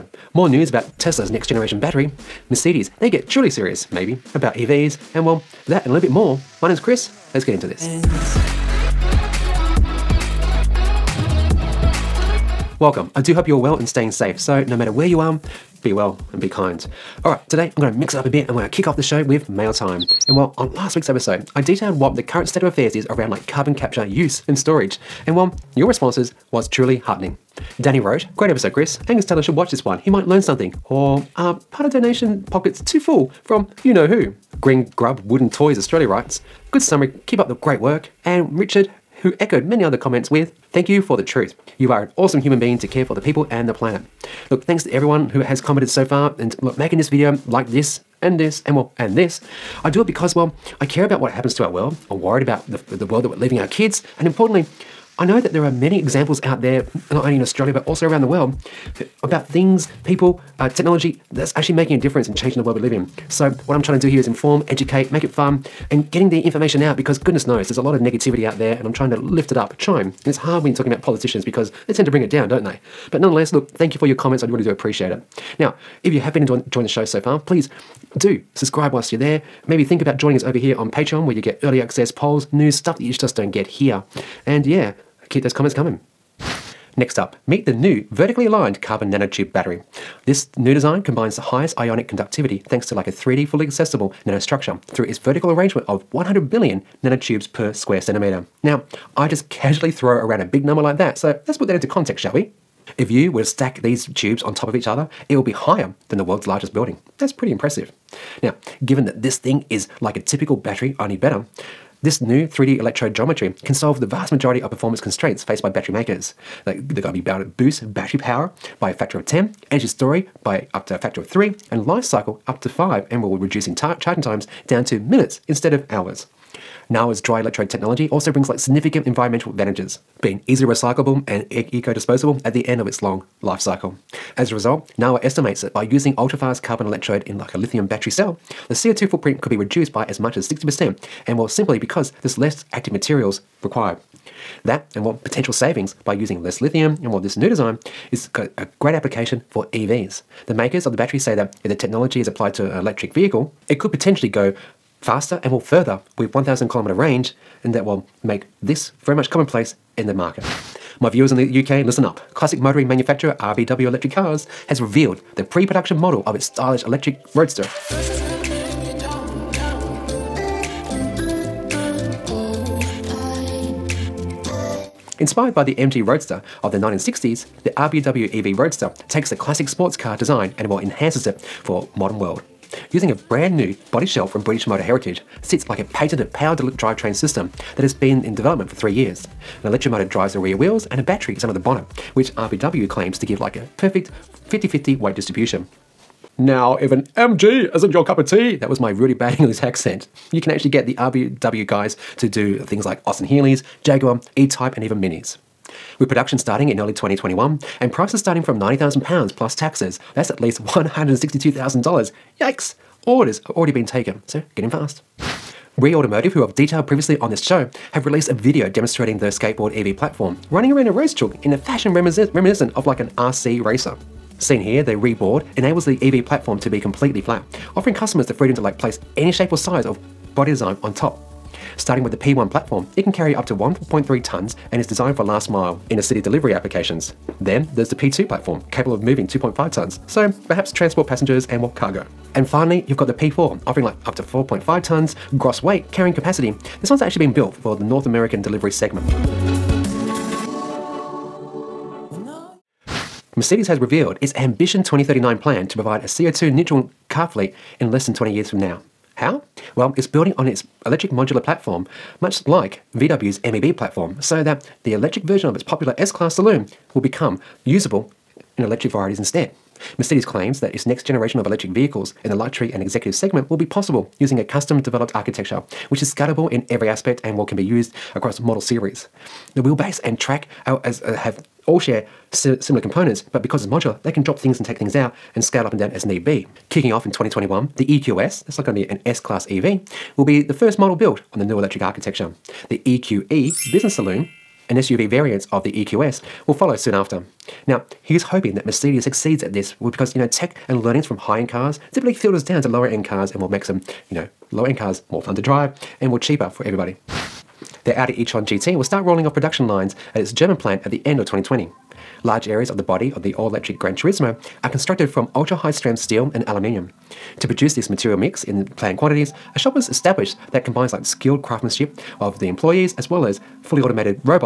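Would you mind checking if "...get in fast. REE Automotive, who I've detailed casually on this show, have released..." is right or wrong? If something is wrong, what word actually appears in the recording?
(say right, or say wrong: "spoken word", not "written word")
wrong: "previously", not "casually".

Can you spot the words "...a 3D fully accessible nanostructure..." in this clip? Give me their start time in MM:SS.
01:33.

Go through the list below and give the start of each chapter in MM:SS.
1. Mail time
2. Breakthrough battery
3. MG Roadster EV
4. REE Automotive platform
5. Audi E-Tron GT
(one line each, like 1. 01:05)
1. 00:12
2. 01:24
3. 02:38
4. 03:31
5. 05:04.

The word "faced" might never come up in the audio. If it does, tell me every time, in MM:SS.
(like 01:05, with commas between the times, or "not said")
01:55.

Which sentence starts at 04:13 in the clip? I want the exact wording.
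Mercedes has revealed its Ambition 2039 plan to provide a CO2 neutral car fleet in less than 20 years from now.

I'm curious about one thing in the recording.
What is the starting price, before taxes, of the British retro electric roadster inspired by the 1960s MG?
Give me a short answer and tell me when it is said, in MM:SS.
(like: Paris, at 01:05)
£90,000, at 03:28.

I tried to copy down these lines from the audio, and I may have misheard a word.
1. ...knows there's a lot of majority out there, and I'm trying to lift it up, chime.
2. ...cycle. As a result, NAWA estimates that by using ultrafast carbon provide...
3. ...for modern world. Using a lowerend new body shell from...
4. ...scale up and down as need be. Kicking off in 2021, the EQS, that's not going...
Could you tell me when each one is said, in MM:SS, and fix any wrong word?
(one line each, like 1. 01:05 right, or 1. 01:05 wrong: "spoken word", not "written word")
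1. 01:07 wrong: "negativity", not "majority"
2. 02:13 wrong: "electrode", not "provide"
3. 03:01 wrong: "brand", not "lowerend"
4. 04:45 right.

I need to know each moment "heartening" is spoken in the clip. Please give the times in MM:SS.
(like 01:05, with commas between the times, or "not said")
00:26.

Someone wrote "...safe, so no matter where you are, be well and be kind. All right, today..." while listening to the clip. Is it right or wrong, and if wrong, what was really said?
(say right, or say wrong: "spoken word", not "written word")
right.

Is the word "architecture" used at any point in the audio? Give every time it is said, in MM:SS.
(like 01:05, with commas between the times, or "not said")
04:35, 04:51.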